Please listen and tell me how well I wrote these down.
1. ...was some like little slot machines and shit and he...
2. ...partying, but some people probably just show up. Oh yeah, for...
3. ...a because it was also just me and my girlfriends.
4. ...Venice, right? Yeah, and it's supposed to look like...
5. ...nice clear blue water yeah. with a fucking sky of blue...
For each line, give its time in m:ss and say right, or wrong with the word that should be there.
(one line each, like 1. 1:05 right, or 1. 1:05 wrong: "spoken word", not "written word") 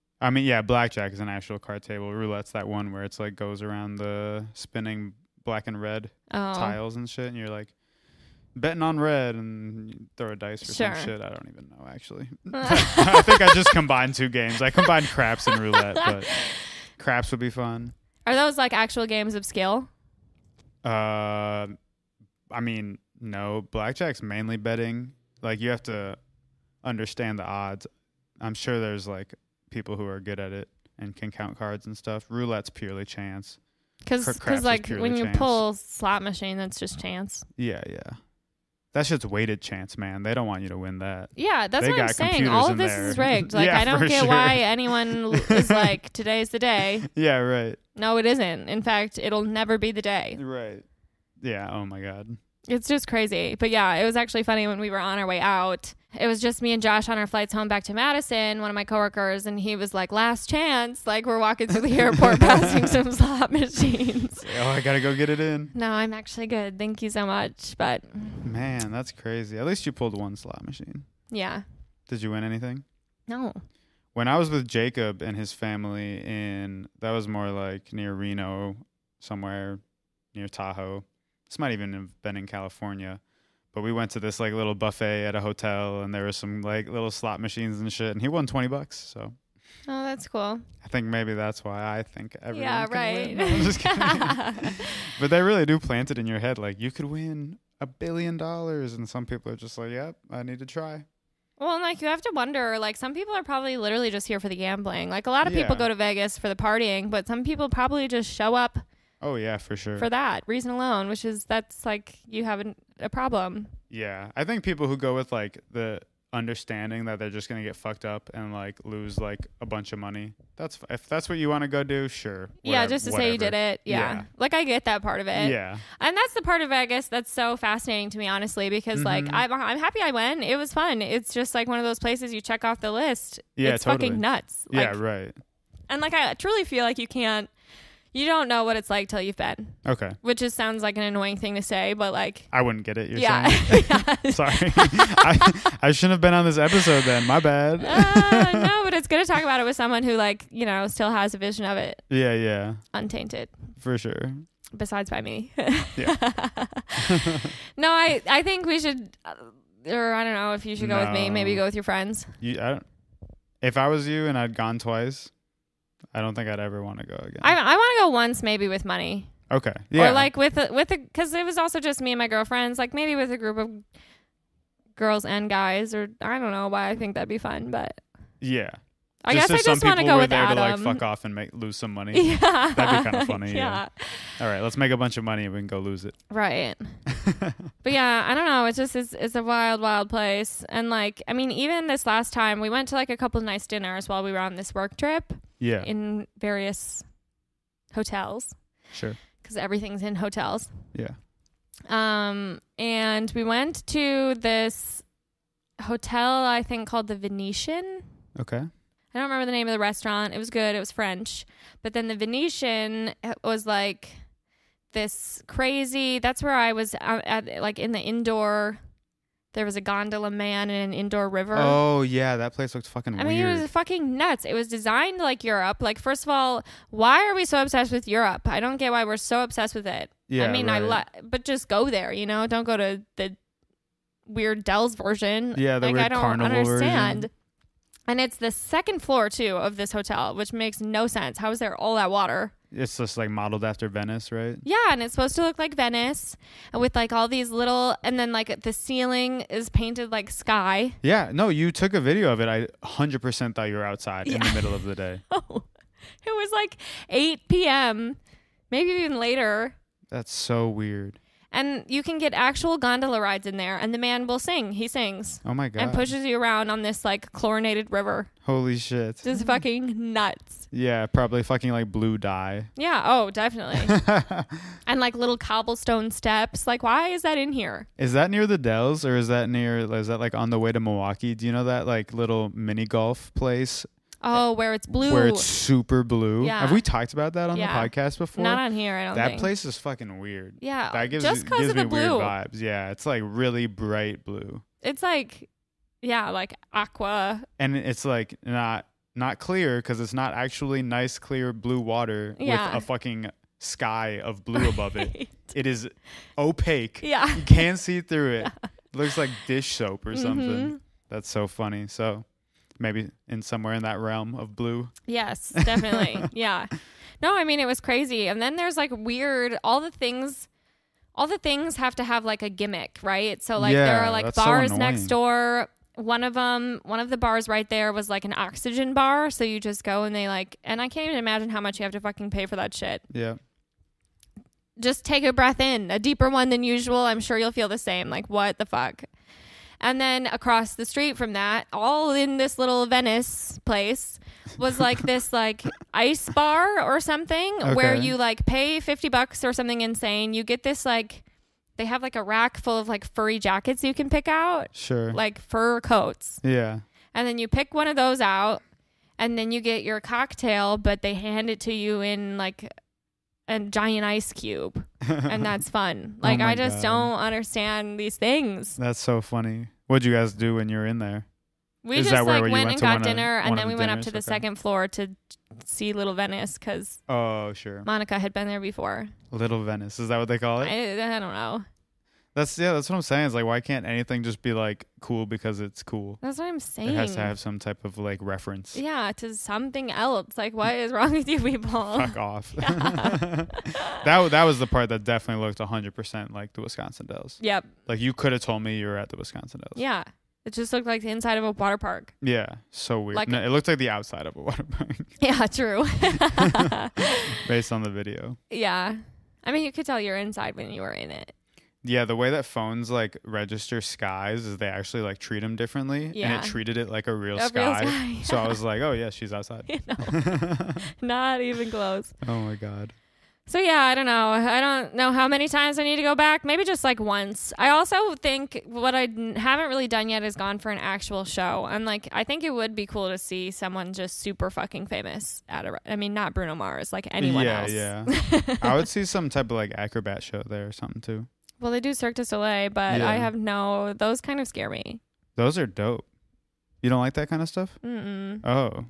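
1. 1:26 right
2. 1:46 right
3. 2:50 right
4. 4:03 right
5. 5:00 right.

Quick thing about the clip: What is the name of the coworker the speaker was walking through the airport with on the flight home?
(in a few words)
Josh.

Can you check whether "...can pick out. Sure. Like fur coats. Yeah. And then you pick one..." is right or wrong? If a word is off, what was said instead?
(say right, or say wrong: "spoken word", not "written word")
right.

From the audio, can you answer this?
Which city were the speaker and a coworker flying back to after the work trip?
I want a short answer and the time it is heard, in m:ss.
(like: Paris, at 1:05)
Madison, at 0:57.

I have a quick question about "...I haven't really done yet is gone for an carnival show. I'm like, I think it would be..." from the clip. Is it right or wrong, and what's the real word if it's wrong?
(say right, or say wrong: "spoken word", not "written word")
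wrong: "actual", not "carnival".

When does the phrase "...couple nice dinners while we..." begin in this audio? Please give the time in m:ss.
3:13.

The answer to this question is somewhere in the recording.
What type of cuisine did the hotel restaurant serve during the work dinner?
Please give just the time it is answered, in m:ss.
3:30.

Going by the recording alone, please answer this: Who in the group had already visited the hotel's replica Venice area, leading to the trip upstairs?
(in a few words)
Monica.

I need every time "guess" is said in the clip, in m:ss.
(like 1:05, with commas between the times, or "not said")
2:06, 2:59.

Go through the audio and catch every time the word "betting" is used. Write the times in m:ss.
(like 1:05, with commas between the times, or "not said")
0:08, 0:24.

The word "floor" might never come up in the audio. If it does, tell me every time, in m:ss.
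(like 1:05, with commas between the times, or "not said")
3:59, 6:14.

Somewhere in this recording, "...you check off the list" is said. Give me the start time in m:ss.
2:12.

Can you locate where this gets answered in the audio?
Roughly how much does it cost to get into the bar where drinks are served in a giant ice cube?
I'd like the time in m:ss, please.
5:48.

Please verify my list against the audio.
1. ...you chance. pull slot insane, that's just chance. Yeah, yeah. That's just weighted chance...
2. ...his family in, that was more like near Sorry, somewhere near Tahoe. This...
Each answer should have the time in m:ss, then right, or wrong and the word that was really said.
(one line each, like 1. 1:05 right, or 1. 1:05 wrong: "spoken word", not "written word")
1. 0:35 wrong: "machine", not "insane"
2. 1:15 wrong: "Reno", not "Sorry".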